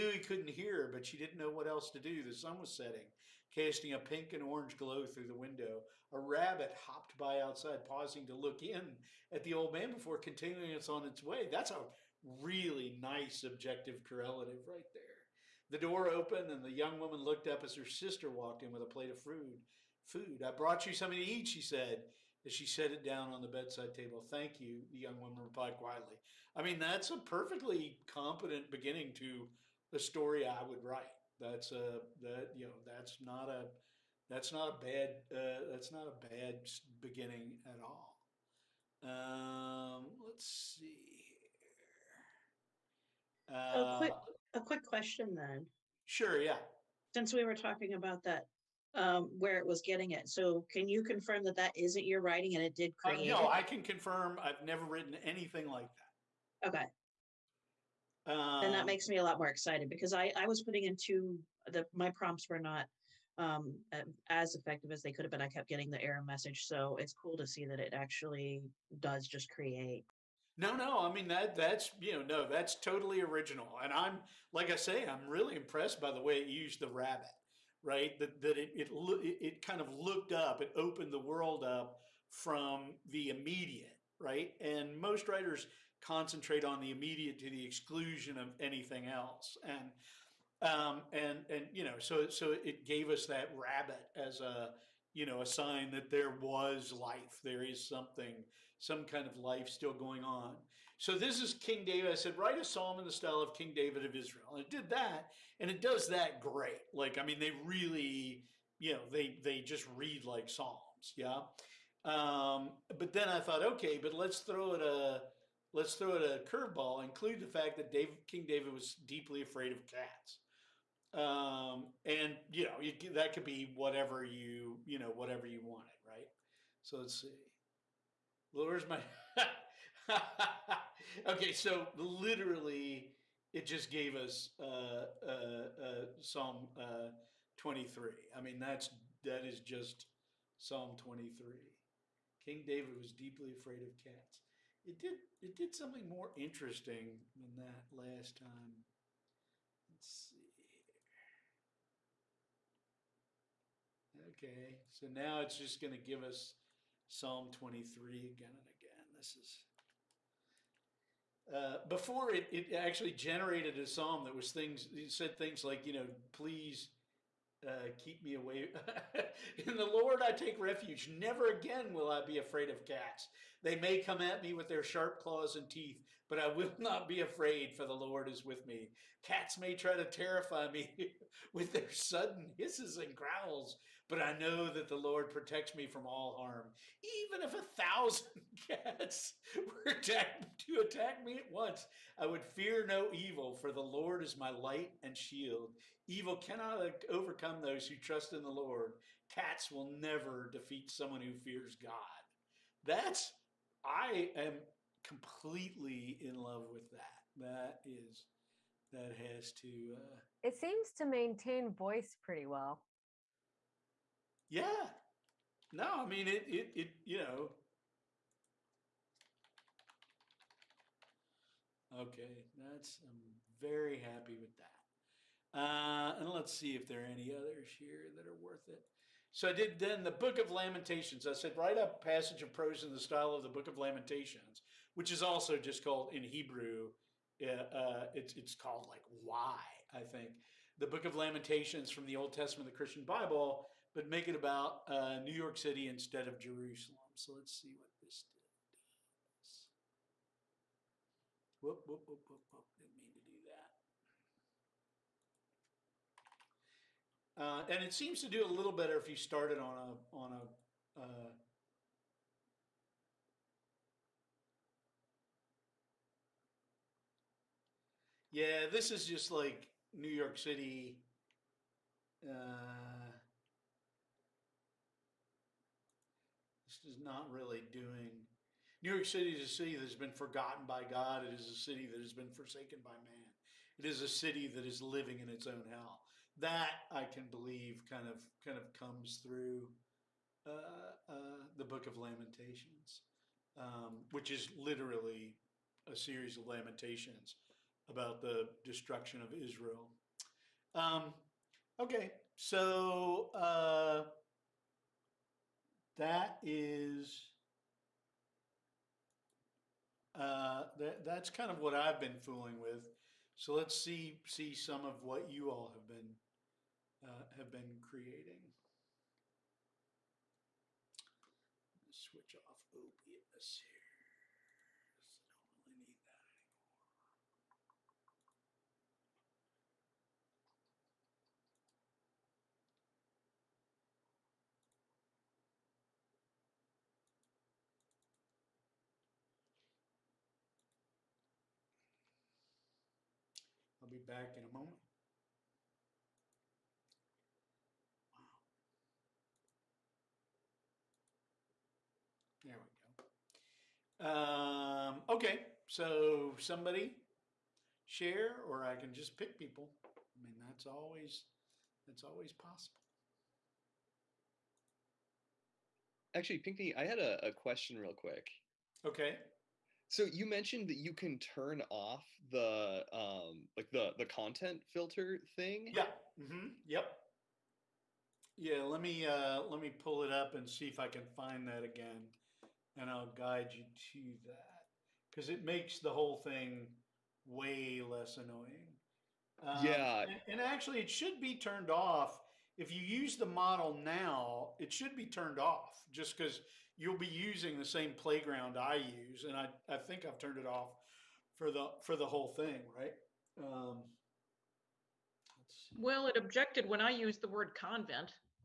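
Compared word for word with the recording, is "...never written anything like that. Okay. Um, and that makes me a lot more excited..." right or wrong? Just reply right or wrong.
right.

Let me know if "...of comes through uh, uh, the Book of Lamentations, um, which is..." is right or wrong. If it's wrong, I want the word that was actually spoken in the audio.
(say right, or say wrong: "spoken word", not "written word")
right.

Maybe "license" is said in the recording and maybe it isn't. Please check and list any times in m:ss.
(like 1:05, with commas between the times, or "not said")
not said.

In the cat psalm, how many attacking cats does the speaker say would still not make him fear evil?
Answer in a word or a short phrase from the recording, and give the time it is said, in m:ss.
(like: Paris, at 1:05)
1,000, at 3:07.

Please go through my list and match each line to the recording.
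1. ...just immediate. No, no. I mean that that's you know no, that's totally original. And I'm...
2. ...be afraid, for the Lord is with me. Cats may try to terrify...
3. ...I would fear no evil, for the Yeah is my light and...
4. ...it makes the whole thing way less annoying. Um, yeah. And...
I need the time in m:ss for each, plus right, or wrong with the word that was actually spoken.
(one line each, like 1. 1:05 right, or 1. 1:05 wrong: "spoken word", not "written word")
1. 1:09 wrong: "create", not "immediate"
2. 2:57 right
3. 3:12 wrong: "Lord", not "Yeah"
4. 6:25 right.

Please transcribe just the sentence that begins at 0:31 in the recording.
That's a that you know that's not a that's not a bad uh, that's not a bad beginning at all.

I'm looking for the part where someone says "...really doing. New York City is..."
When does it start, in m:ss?
4:37.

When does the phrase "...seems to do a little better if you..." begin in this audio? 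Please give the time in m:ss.
4:17.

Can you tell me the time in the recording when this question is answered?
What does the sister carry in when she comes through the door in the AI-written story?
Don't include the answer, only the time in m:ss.
0:18.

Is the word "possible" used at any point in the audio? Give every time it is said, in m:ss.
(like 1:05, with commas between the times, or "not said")
6:02.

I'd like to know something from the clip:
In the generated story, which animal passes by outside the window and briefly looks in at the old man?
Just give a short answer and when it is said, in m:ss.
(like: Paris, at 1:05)
A rabbit, at 0:06.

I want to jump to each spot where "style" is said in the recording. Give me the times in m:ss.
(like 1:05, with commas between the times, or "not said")
1:43, 3:52.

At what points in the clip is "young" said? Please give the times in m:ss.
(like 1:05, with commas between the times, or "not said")
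0:16, 0:24.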